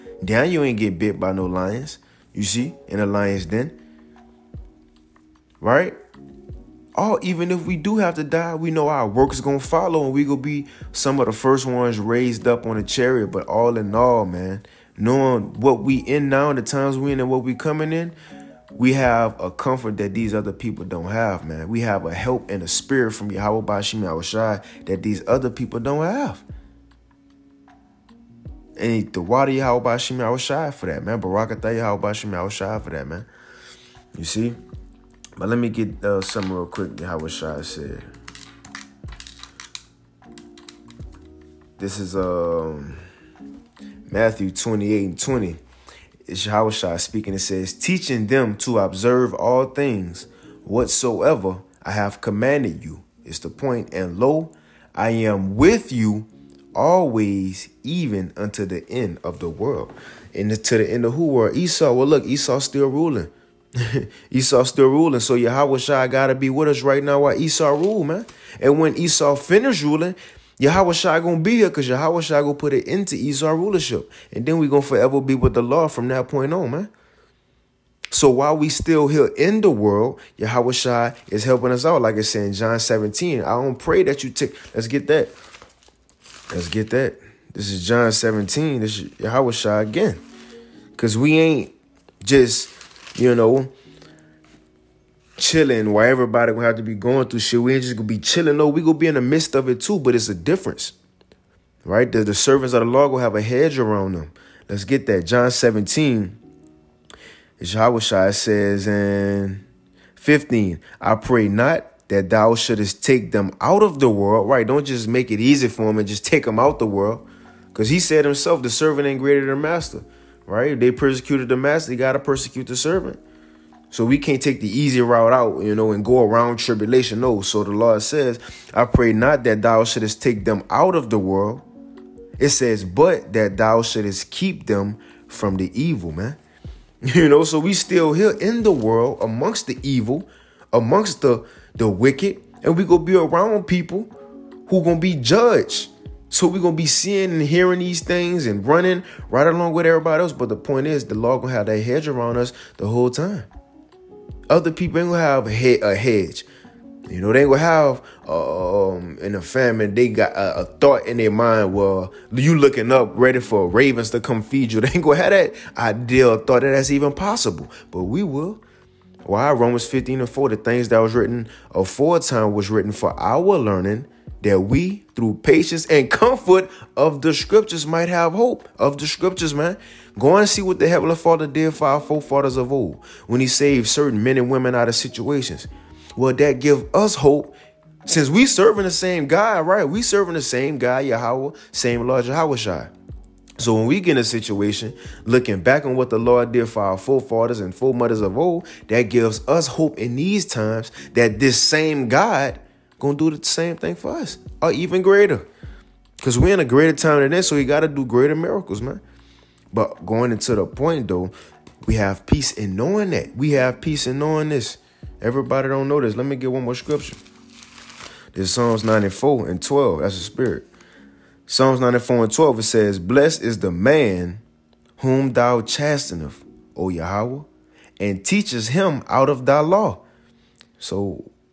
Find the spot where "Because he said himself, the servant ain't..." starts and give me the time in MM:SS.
01:57.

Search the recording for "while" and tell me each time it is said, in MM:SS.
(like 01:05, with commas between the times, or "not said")
01:07, 01:18.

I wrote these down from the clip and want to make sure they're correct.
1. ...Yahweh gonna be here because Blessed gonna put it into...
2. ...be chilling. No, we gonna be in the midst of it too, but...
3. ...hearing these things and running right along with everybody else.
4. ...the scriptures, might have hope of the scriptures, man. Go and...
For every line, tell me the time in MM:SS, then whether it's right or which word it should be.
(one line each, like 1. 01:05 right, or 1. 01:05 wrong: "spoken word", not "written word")
1. 01:10 wrong: "Yahweh", not "Blessed"
2. 01:38 right
3. 02:27 right
4. 02:57 right.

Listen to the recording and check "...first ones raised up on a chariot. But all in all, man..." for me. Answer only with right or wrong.
right.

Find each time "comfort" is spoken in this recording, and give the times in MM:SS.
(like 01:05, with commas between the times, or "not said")
00:19, 02:56.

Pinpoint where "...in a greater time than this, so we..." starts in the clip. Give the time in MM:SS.
03:26.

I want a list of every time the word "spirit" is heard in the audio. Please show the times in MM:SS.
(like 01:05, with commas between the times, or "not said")
00:22, 03:40.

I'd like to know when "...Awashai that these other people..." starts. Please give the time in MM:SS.
00:24.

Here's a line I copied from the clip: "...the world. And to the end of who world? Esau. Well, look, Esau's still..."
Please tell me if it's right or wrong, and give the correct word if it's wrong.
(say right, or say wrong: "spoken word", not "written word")
right.